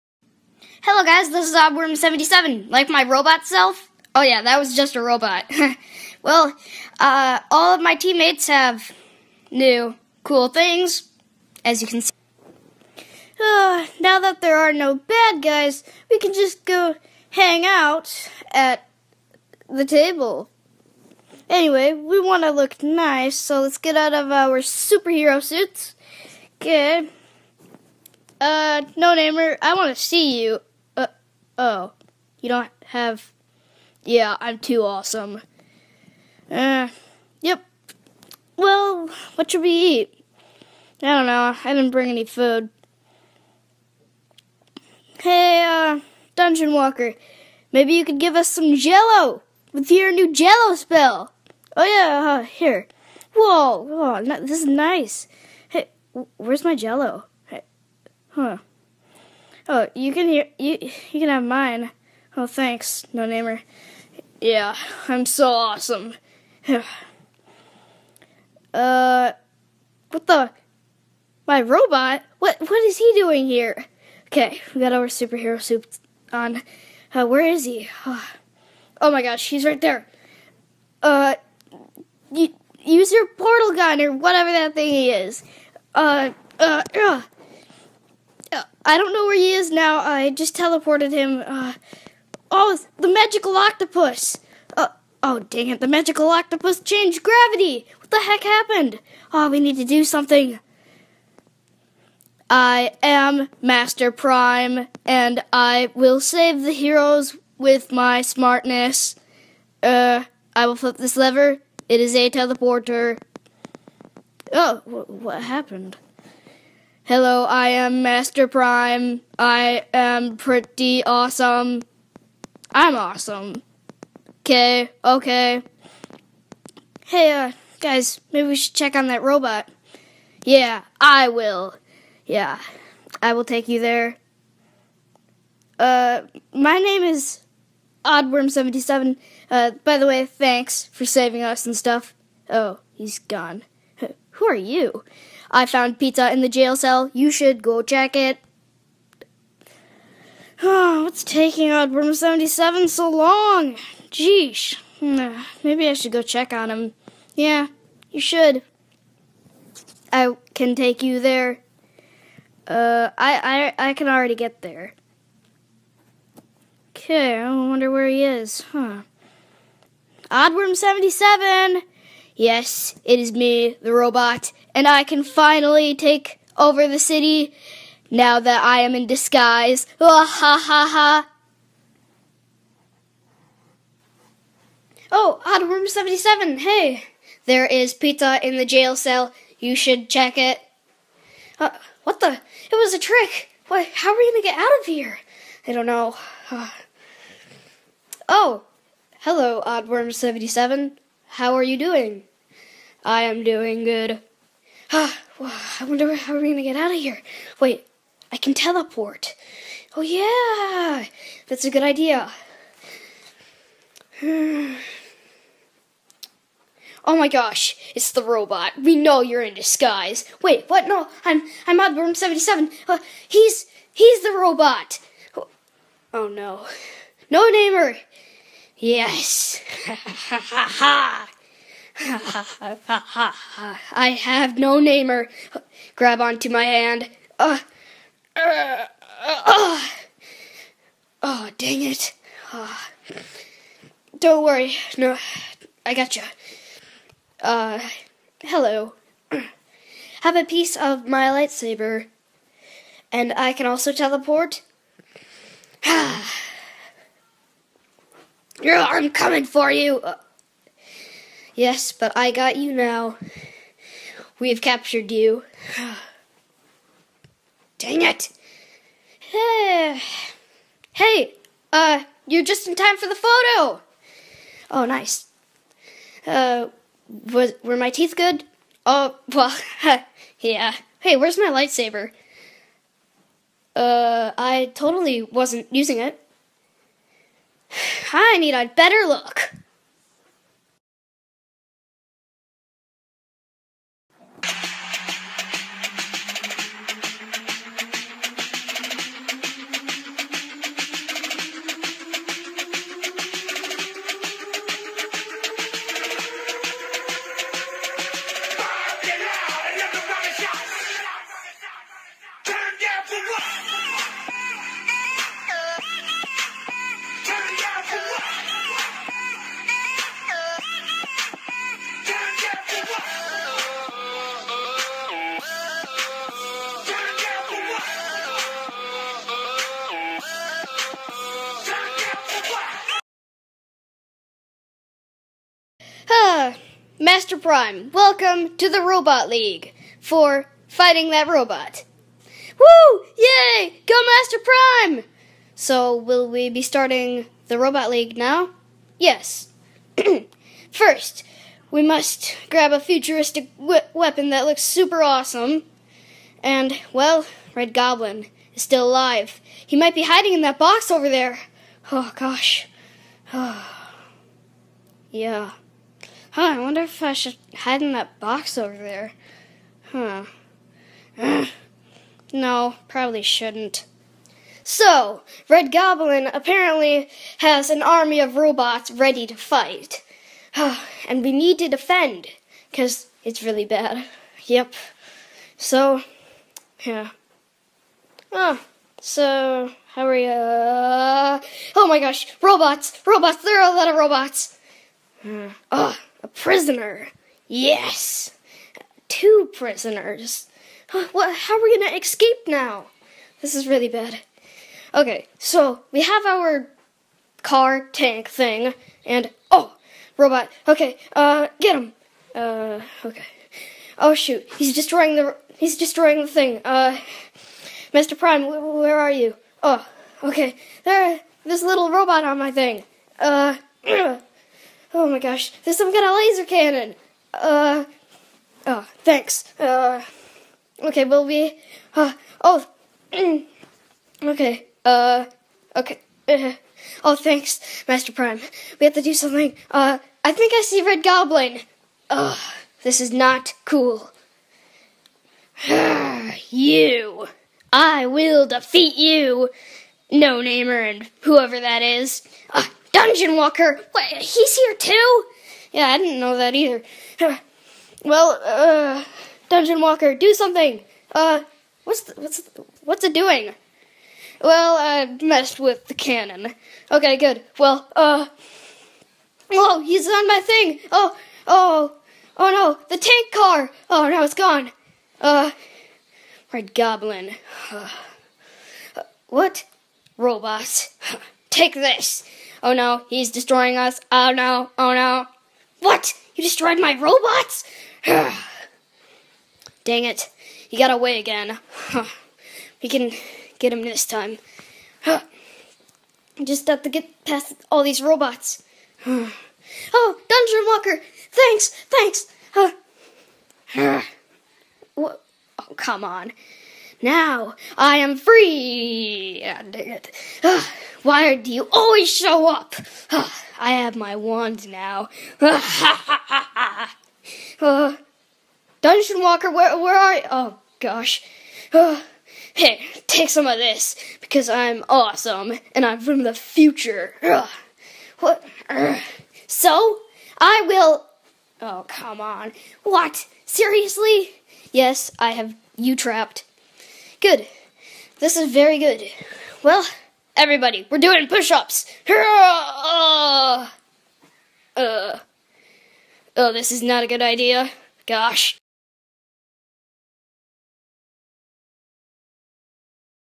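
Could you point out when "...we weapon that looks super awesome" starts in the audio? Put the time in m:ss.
5:53.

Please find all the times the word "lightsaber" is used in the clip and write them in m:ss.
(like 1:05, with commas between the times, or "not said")
4:11, 4:41.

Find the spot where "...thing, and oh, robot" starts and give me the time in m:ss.
6:48.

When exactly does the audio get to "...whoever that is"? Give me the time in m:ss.
7:31.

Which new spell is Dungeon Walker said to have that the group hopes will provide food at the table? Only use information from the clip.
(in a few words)
jello spell.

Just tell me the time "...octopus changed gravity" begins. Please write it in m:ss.
1:36.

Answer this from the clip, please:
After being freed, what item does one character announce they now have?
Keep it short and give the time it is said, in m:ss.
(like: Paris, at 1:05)
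wand, at 8:33.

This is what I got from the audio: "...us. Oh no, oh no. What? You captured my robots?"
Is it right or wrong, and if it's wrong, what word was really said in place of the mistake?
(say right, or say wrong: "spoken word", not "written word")
wrong: "destroyed", not "captured".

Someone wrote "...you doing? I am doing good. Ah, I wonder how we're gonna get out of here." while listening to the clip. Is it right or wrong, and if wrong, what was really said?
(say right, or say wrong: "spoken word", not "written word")
right.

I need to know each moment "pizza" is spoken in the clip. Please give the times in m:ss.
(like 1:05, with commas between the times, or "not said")
2:25, 3:07.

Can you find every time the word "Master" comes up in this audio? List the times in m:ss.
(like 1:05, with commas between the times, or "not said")
1:43, 1:58, 5:36, 5:44, 7:17.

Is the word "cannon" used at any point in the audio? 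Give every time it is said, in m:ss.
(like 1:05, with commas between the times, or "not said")
7:06, 7:45.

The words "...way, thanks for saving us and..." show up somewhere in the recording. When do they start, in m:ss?
2:20.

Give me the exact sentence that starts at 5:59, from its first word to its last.
He might be hiding in that box over there.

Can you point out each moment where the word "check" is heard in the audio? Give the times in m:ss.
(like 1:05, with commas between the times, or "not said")
2:08, 2:27, 2:36, 3:10.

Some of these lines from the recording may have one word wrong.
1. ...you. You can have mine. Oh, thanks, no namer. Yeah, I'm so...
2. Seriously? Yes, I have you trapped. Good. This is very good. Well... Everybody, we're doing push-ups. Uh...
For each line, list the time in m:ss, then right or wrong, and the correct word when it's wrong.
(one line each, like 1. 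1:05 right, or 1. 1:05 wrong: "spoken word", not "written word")
1. 1:00 right
2. 8:53 right.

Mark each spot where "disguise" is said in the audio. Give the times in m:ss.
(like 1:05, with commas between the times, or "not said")
2:59, 3:39.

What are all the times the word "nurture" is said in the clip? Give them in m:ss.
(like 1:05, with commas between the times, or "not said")
not said.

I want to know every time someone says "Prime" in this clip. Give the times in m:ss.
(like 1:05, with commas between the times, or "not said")
1:44, 1:58, 5:37, 5:44, 6:58, 7:18.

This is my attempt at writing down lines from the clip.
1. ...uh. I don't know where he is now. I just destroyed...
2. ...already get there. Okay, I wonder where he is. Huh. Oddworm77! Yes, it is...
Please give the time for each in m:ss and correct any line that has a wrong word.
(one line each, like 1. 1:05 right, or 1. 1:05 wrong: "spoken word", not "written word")
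1. 1:26 wrong: "teleported", not "destroyed"
2. 2:44 right.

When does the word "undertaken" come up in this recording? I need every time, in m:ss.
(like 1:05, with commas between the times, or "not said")
not said.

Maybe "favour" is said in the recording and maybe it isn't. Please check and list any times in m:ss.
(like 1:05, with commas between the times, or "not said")
not said.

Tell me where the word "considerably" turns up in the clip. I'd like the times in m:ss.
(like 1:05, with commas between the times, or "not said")
not said.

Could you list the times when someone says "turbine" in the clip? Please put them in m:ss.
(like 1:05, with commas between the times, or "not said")
not said.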